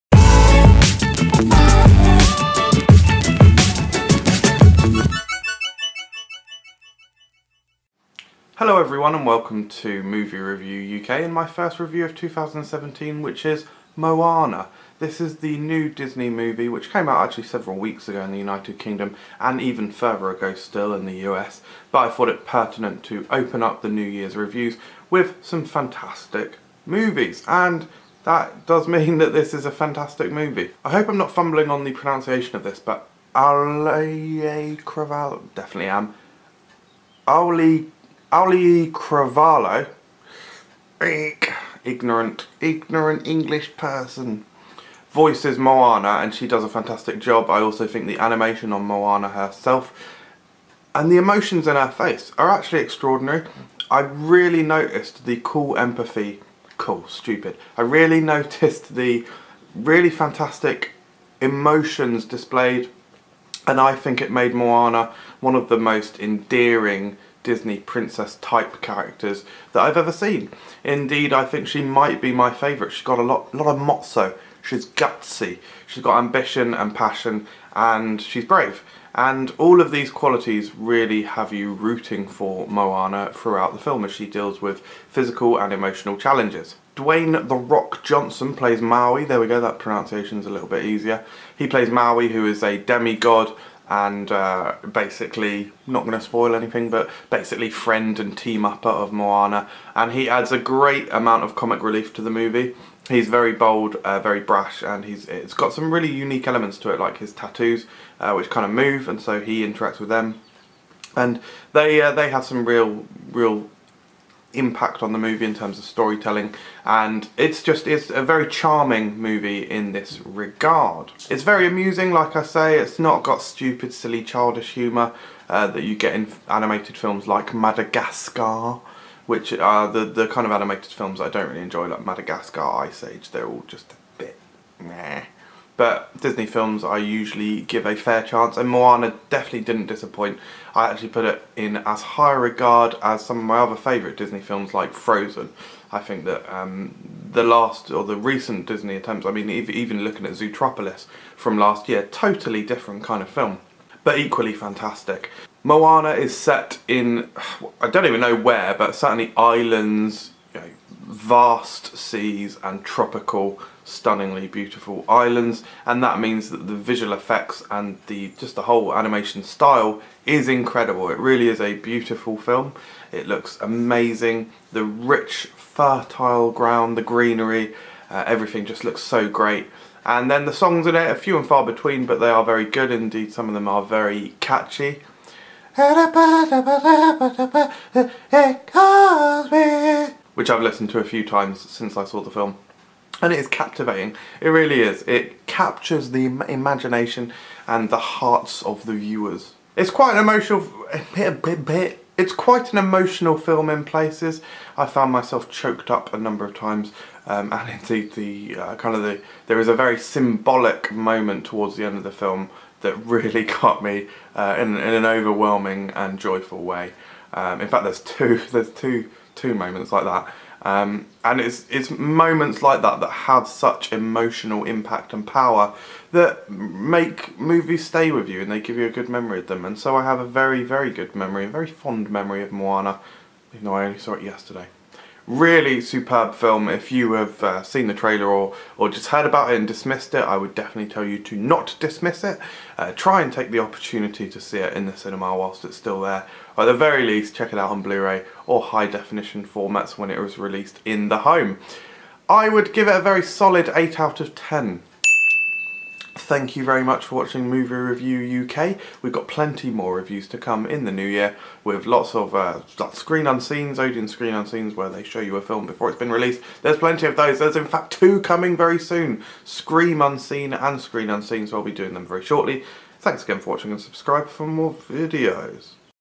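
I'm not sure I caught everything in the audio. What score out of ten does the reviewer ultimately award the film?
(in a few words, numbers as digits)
8.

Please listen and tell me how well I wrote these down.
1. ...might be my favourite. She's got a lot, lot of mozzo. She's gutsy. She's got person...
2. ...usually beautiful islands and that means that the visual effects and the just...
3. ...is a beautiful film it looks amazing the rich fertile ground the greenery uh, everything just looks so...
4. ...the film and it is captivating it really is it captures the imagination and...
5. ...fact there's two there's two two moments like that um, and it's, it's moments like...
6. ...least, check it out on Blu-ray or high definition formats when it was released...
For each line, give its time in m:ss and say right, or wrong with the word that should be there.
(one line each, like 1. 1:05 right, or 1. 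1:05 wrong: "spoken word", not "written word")
1. 1:11 wrong: "ambition", not "person"
2. 2:43 wrong: "stunningly", not "usually"
3. 2:51 right
4. 3:12 right
5. 3:37 right
6. 4:07 right.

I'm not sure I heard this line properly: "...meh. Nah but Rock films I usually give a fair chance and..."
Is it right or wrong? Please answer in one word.
wrong.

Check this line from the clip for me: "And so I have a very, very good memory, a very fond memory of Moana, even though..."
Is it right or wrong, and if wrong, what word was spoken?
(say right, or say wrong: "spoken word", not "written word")
right.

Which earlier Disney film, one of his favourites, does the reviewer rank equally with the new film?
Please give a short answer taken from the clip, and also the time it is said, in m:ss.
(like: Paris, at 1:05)
Frozen, at 2:24.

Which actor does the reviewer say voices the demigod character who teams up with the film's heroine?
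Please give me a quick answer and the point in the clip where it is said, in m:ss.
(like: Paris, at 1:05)
Dwayne The Rock Johnson, at 1:26.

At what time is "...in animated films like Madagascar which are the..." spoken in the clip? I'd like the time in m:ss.
2:06.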